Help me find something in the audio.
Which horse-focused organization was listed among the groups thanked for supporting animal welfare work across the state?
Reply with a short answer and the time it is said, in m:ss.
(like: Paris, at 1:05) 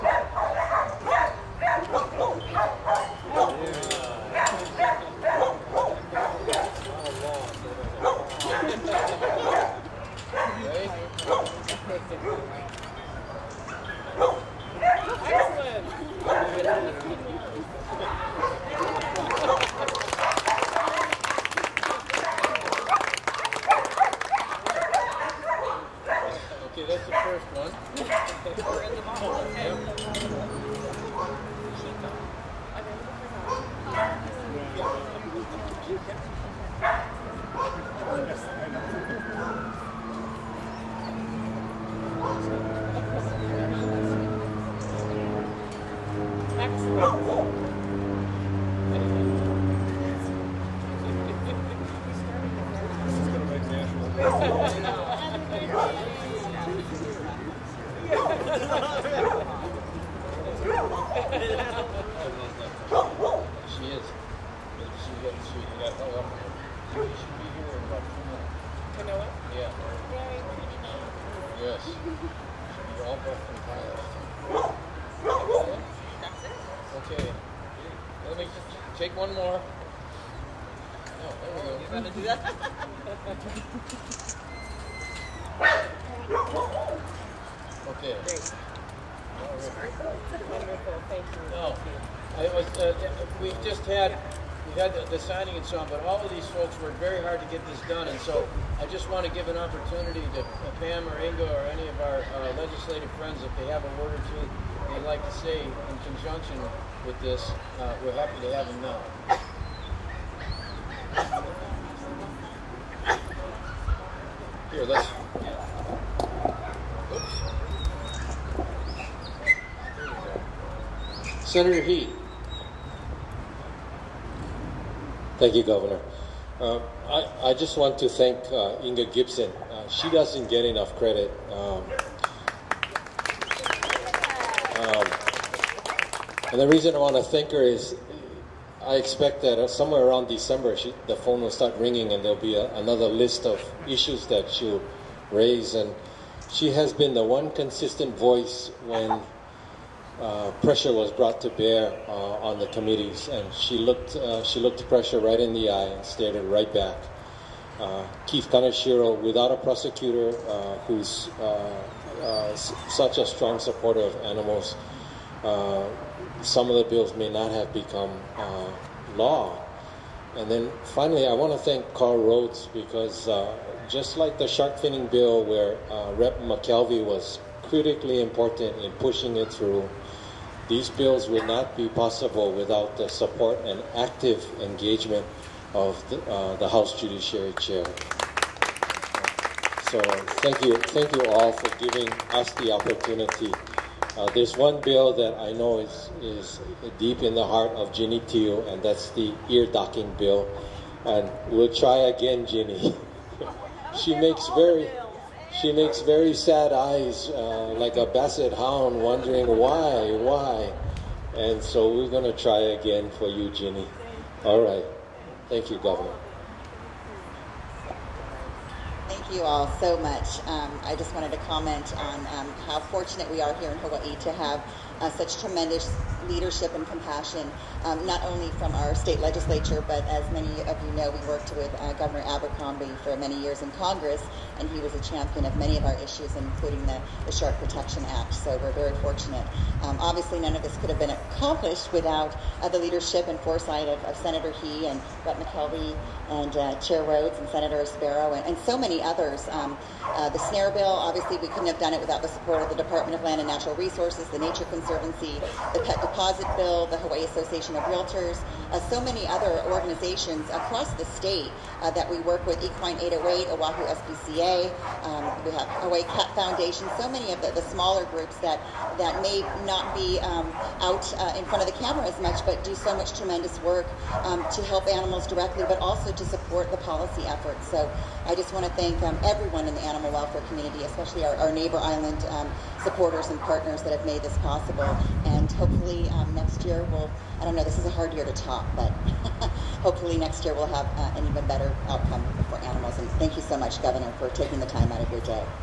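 Equine 808, at 4:22.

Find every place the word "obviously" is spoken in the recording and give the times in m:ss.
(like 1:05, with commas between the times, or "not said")
4:00, 4:10.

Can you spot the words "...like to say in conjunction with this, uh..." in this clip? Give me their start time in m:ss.
1:45.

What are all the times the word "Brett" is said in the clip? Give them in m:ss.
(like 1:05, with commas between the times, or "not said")
4:05.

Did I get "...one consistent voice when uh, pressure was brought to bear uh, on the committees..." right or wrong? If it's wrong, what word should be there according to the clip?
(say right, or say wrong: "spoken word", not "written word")
right.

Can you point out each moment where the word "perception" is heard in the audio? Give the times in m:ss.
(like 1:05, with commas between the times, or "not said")
not said.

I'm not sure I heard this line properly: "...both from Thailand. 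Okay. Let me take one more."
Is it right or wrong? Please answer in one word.
right.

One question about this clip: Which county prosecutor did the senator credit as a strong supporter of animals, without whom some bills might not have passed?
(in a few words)
Keith Kaneshiro.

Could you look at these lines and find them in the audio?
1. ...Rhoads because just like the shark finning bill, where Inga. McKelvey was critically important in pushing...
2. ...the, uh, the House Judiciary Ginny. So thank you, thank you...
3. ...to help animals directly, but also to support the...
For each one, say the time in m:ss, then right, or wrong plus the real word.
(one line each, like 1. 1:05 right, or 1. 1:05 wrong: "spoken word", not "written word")
1. 2:52 wrong: "Rep", not "Inga"
2. 3:06 wrong: "Chair", not "Ginny"
3. 4:34 right.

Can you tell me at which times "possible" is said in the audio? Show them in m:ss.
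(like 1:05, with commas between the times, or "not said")
3:01, 4:44.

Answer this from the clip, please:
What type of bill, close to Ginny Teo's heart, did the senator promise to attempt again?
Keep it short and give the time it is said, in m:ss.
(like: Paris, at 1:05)
ear docking bill, at 3:19.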